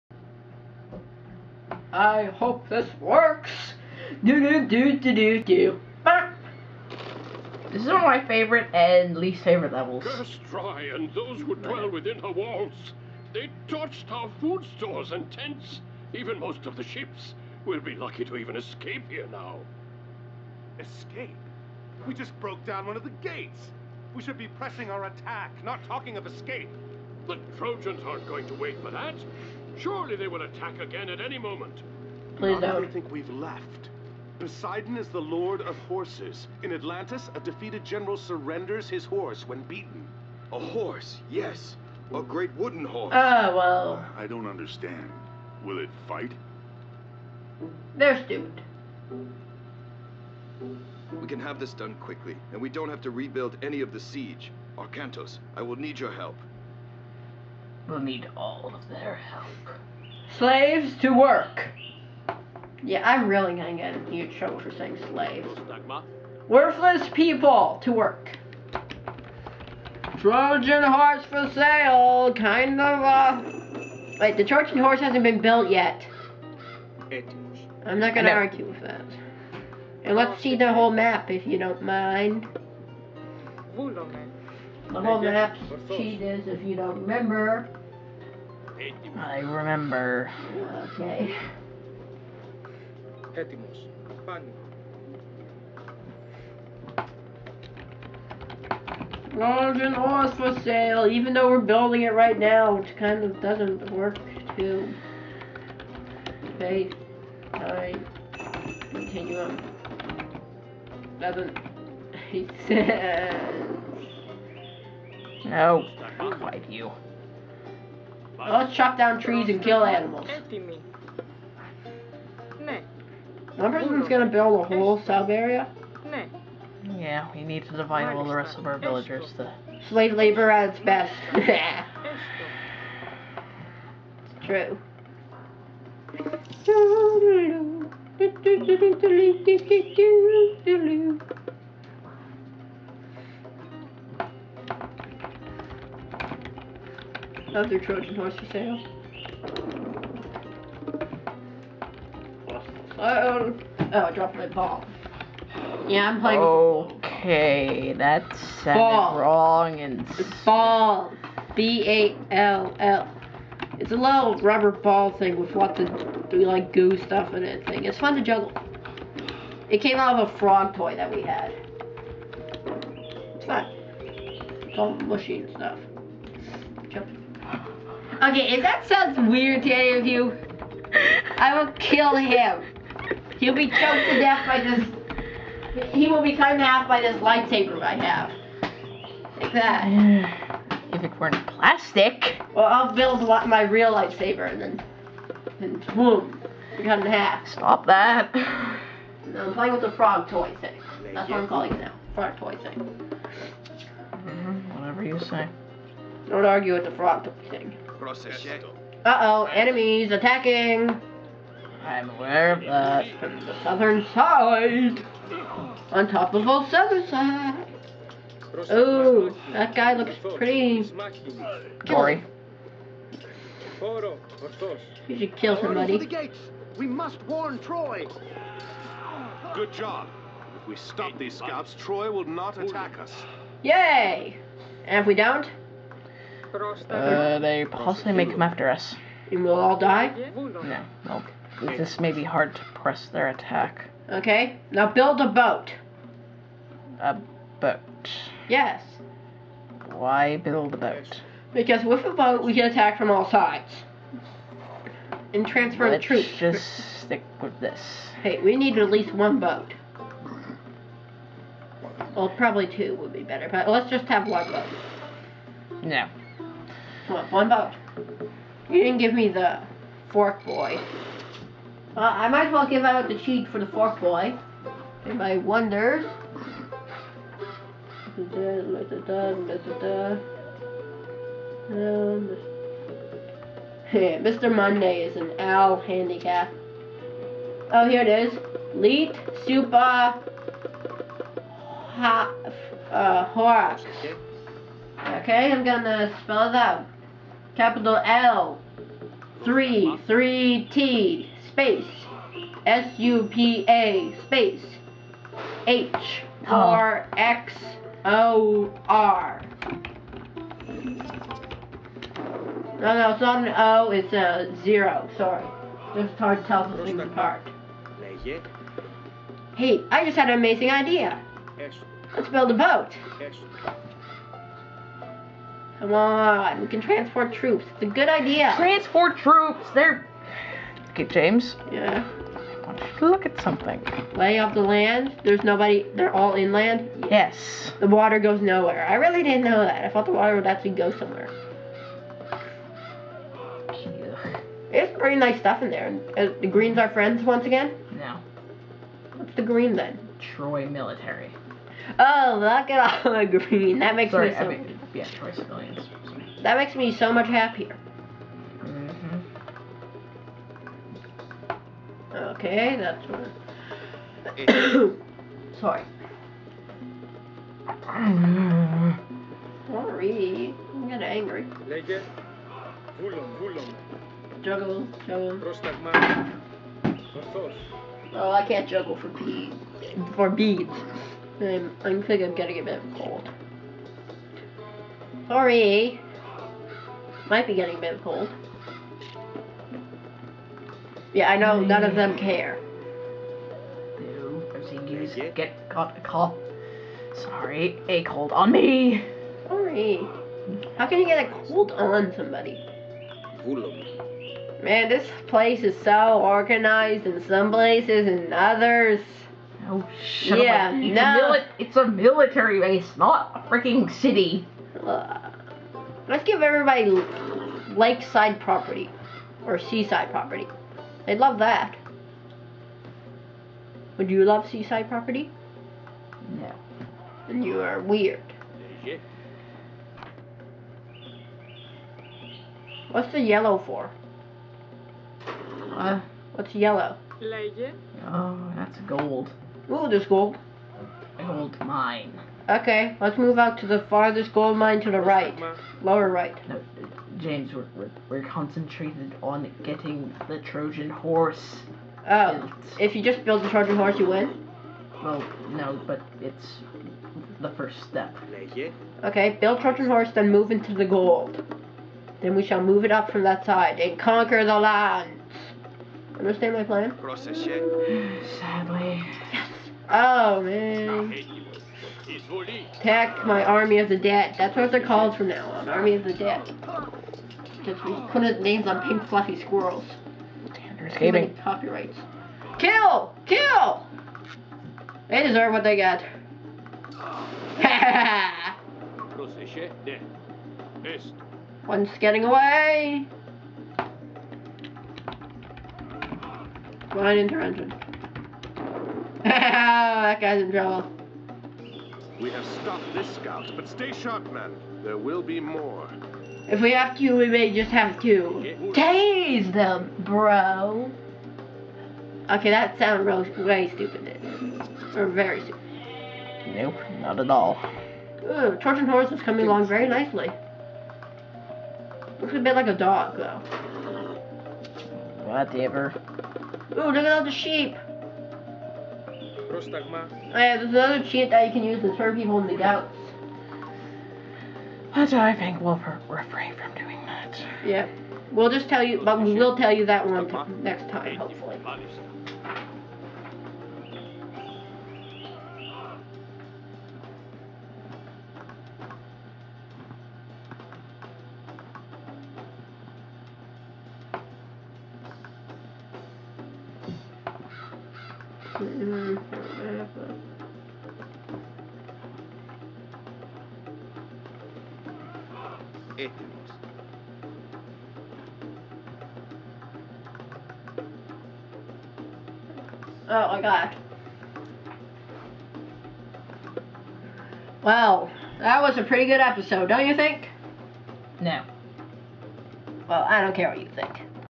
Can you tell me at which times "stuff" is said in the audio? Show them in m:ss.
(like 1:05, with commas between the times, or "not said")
2:46, 2:55, 5:45.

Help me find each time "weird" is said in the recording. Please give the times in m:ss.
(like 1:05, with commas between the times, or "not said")
2:59, 7:07.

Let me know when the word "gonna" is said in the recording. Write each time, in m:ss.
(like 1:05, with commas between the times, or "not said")
1:03, 1:18, 2:04, 4:55.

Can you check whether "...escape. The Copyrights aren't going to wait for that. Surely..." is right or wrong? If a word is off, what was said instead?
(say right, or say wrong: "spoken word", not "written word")
wrong: "Trojans", not "Copyrights".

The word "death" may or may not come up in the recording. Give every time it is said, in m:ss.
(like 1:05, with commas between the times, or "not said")
3:04.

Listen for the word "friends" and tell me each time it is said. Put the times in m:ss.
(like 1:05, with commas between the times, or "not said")
5:46.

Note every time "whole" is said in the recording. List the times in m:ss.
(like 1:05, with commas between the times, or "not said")
1:20, 1:25, 2:04.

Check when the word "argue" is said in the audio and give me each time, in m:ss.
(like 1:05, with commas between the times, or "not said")
1:18, 3:26.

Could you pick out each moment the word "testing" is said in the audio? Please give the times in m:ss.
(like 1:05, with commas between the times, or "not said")
not said.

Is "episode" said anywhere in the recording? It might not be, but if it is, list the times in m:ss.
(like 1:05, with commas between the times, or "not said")
9:39.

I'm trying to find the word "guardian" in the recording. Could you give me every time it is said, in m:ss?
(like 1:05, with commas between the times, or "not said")
not said.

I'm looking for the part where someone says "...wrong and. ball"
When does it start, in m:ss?
2:38.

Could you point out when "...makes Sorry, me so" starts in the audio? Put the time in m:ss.
5:53.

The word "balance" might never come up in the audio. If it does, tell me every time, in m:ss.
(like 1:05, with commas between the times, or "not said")
not said.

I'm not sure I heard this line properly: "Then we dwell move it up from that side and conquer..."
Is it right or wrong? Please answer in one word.
wrong.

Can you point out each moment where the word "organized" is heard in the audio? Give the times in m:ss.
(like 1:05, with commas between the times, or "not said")
6:46.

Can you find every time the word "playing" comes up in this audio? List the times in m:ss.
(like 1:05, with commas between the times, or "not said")
2:36, 3:19.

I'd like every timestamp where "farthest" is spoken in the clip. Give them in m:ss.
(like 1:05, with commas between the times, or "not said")
7:23.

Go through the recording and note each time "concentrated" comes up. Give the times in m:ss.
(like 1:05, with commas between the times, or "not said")
7:28.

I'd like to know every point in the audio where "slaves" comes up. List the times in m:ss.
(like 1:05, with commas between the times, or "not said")
1:00, 1:05, 2:09.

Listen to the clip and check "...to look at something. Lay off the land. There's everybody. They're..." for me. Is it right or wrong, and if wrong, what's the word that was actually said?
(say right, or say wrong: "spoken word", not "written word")
wrong: "nobody", not "everybody".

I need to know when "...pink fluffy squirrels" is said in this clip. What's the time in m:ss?
7:58.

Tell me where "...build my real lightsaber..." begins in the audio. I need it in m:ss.
3:12.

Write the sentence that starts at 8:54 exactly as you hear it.
That's I think we'll refrain from doing that.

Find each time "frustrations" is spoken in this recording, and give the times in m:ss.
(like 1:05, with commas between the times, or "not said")
not said.